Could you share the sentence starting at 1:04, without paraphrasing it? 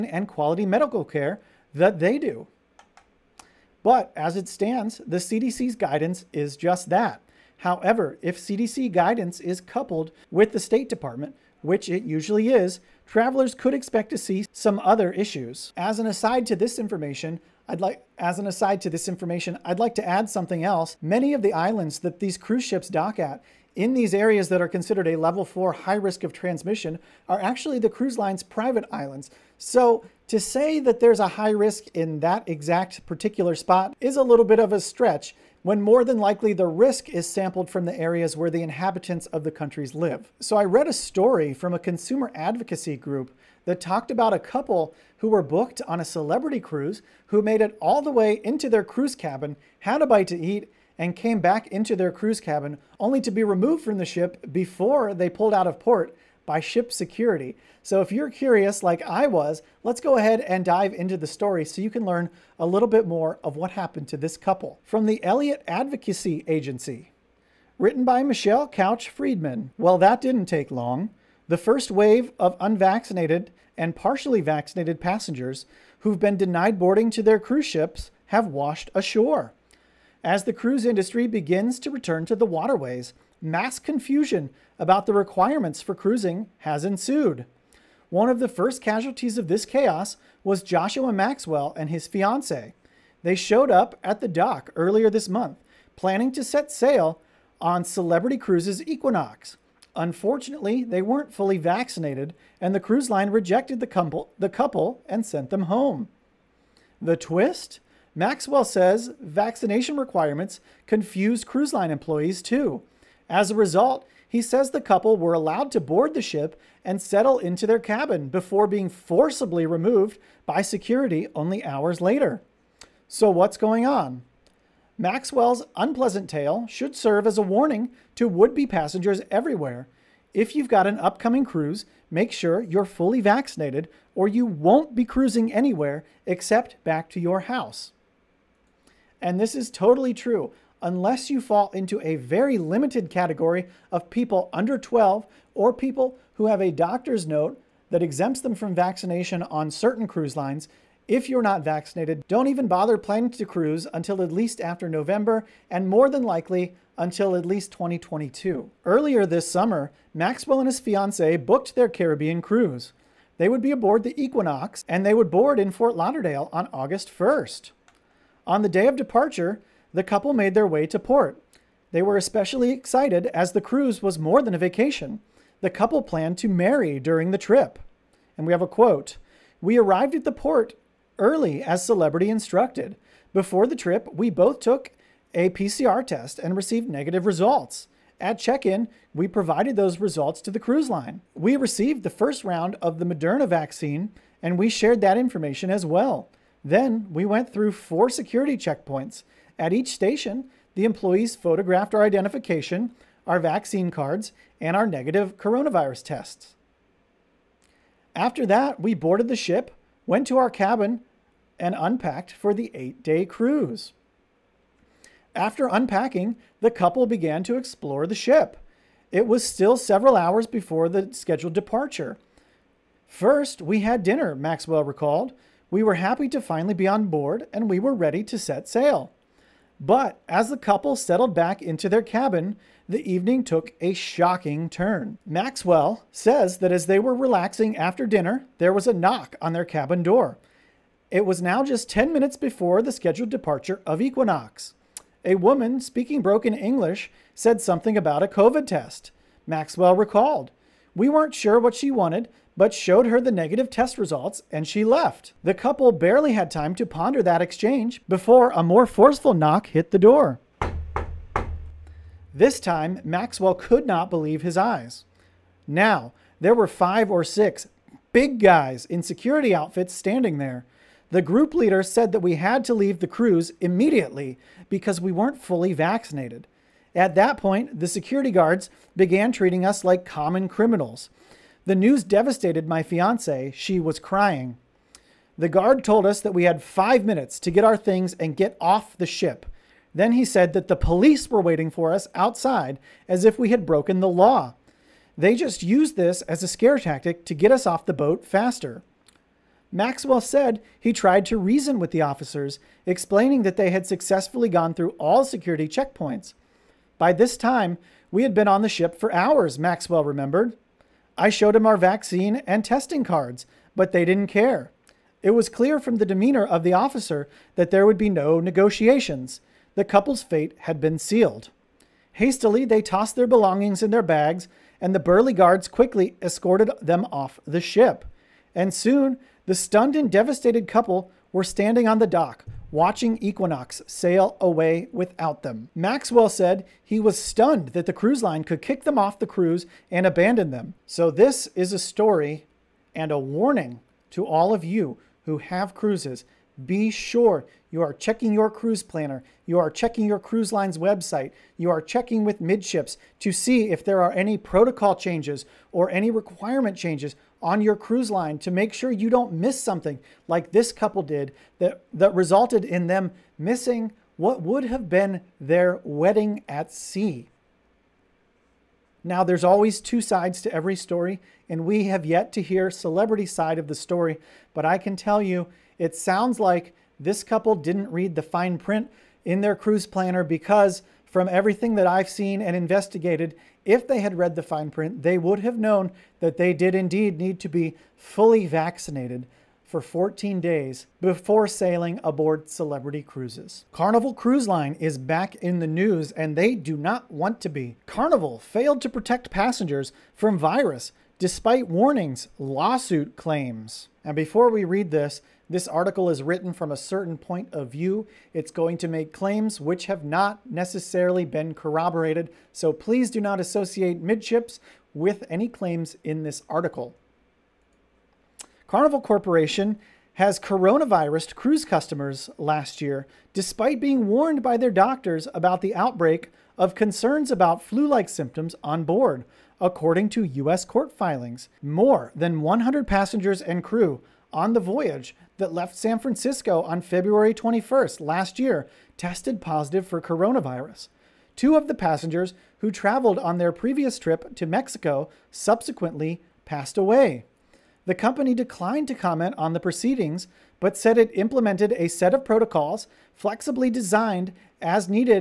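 From the Elliott Advocacy Agency, written by Michelle Couch Friedman.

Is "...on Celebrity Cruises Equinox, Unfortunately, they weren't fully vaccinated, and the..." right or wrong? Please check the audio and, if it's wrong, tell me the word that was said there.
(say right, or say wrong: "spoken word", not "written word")
right.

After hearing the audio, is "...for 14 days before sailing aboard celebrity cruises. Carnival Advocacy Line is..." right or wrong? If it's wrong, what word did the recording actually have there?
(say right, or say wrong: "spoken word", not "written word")
wrong: "Cruise", not "Advocacy".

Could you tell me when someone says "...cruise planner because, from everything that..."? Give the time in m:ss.
6:19.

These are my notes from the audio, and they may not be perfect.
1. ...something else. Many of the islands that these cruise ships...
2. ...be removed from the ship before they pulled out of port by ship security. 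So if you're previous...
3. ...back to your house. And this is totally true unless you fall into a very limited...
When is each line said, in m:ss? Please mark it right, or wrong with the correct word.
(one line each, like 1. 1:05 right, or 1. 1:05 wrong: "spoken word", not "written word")
1. 0:20 right
2. 0:53 wrong: "curious", not "previous"
3. 2:16 right.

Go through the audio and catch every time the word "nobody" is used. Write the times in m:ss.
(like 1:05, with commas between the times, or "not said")
not said.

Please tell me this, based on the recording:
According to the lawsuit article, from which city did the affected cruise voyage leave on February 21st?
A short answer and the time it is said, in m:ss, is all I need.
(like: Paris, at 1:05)
San Francisco, at 7:15.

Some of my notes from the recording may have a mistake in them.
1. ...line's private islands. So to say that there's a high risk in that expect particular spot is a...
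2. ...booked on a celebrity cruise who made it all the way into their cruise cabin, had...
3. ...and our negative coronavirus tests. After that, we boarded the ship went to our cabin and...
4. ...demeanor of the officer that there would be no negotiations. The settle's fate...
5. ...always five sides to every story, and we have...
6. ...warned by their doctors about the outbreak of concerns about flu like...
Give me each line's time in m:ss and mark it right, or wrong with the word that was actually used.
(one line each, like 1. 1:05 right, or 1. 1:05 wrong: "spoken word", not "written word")
1. 0:28 wrong: "exact", not "expect"
2. 0:45 right
3. 3:24 right
4. 5:16 wrong: "couple", not "settle"
5. 6:09 wrong: "two", not "five"
6. 7:04 right.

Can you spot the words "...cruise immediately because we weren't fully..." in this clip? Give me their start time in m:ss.
4:33.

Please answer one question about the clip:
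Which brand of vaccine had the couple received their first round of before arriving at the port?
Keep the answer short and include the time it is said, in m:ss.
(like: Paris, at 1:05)
Moderna, at 3:13.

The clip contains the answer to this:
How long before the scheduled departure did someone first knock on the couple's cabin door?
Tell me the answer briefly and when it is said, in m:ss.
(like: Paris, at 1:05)
10 minutes, at 4:01.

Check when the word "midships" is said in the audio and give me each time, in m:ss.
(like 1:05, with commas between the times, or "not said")
5:52, 6:54.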